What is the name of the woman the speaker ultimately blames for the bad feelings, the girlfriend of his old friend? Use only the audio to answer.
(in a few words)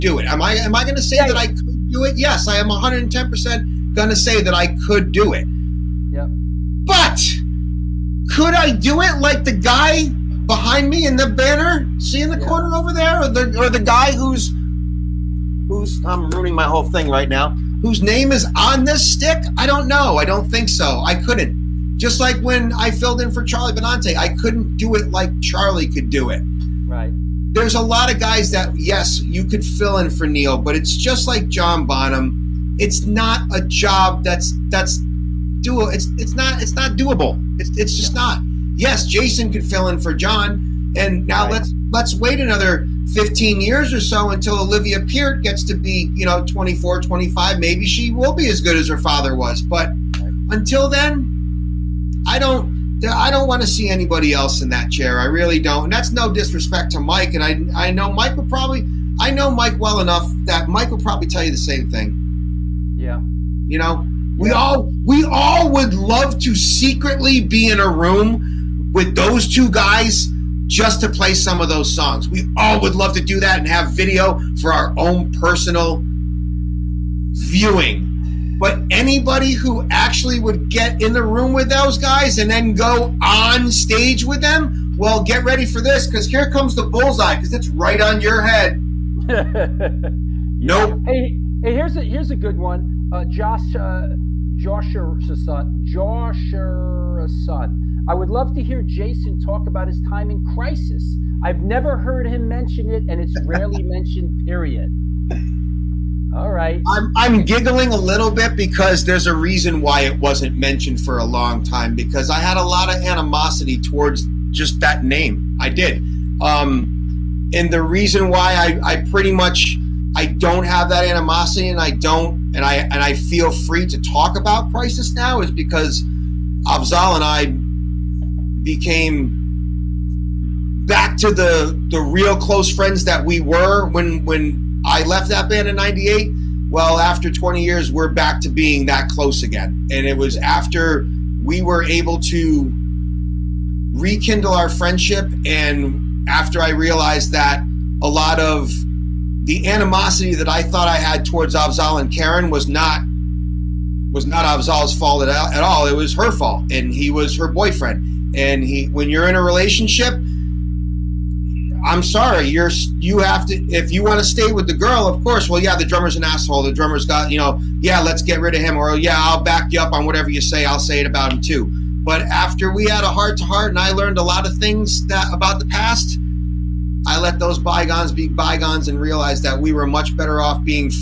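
Karyn.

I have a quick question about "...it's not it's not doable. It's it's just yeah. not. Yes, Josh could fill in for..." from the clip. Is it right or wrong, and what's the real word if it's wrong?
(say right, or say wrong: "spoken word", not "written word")
wrong: "Jason", not "Josh".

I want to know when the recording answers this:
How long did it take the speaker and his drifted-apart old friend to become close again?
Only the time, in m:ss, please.
2:17.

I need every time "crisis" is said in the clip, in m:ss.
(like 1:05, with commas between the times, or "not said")
1:40, 2:04.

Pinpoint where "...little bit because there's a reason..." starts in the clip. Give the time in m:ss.
1:47.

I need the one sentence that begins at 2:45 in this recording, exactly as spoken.
Well, yeah, the drummer's an asshole.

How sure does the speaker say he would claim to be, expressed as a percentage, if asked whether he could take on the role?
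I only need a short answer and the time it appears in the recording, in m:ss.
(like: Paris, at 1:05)
110 percent, at 0:02.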